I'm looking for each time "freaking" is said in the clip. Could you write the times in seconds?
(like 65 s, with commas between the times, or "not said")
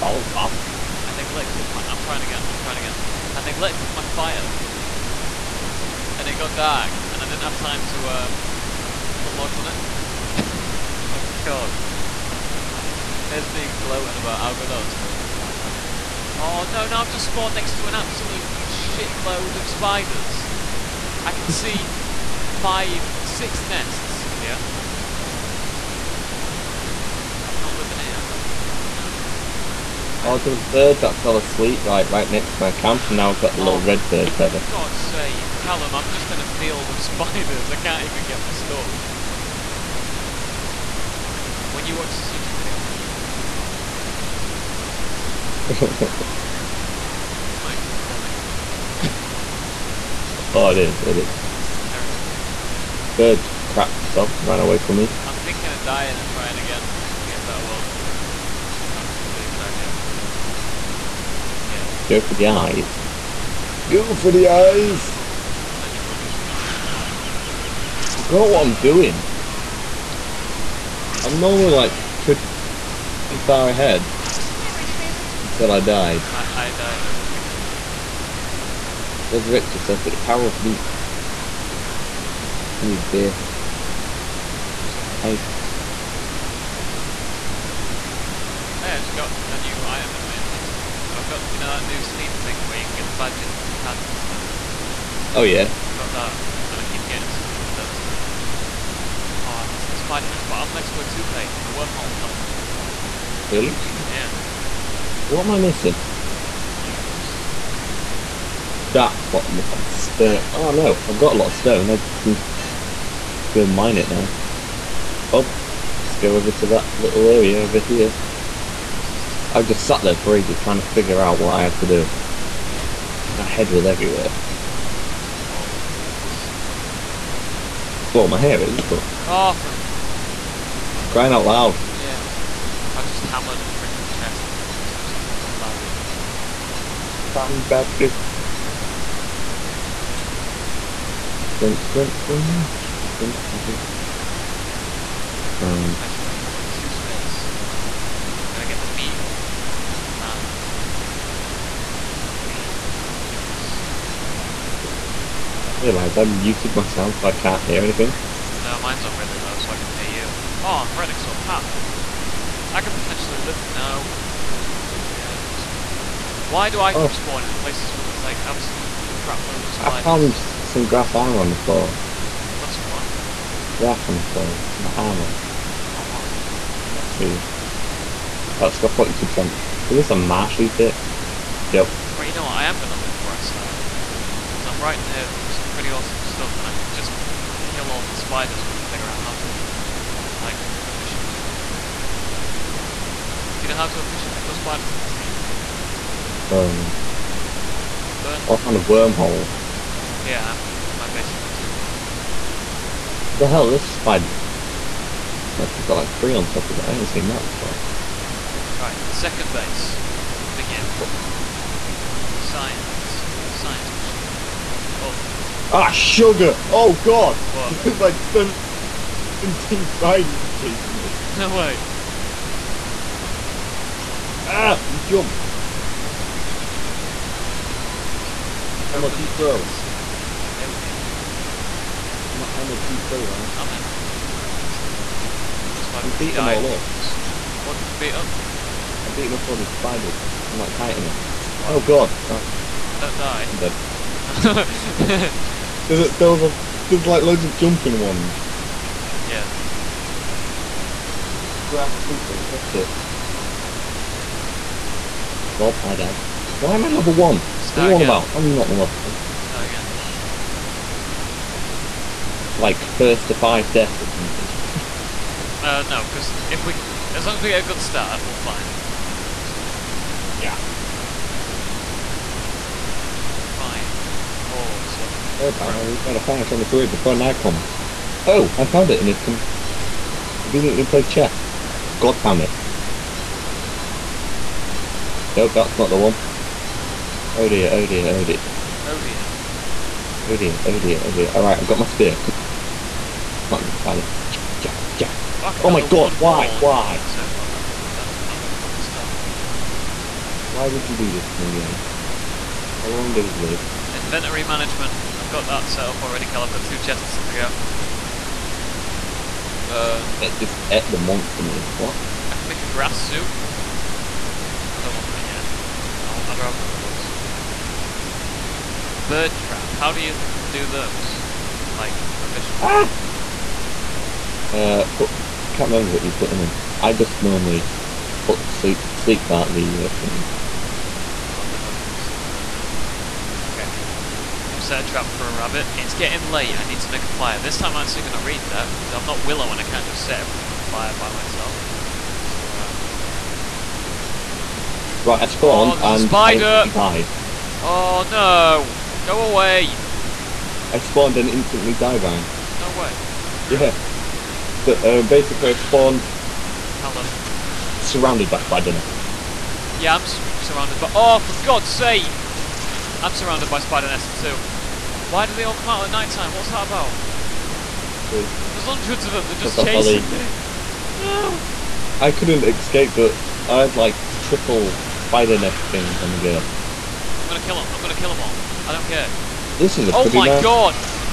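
44 s, 133 s.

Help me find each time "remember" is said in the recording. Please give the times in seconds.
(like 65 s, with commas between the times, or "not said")
325 s.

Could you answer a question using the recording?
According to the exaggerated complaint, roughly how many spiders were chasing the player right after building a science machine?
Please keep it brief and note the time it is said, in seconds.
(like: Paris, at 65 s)
17, at 218 s.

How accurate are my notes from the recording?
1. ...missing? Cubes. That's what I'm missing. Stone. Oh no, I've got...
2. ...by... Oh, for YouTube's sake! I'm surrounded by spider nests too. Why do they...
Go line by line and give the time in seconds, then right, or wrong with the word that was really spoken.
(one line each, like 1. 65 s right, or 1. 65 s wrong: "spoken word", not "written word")
1. 105 s right
2. 360 s wrong: "God", not "YouTube".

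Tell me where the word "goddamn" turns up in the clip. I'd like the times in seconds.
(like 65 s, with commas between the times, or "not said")
not said.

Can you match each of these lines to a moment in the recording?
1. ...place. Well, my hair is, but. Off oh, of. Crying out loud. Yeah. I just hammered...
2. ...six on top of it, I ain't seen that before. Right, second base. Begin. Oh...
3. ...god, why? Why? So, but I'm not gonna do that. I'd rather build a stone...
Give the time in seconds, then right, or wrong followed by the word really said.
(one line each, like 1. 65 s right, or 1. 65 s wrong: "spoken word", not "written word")
1. 126 s right
2. 206 s wrong: "three", not "six"
3. 295 s right.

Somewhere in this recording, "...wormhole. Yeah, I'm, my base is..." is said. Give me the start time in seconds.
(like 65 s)
198 s.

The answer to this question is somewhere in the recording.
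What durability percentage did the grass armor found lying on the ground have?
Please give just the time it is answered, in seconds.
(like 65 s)
178 s.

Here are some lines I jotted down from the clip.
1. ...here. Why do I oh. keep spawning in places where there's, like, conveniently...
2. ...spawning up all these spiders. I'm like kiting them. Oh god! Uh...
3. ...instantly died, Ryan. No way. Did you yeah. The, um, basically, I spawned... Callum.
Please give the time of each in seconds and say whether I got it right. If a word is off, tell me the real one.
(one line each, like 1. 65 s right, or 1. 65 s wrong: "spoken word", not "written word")
1. 165 s wrong: "absolutely", not "conveniently"
2. 239 s wrong: "beating", not "spawning"
3. 351 s right.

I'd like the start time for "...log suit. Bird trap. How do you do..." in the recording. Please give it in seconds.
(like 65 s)
316 s.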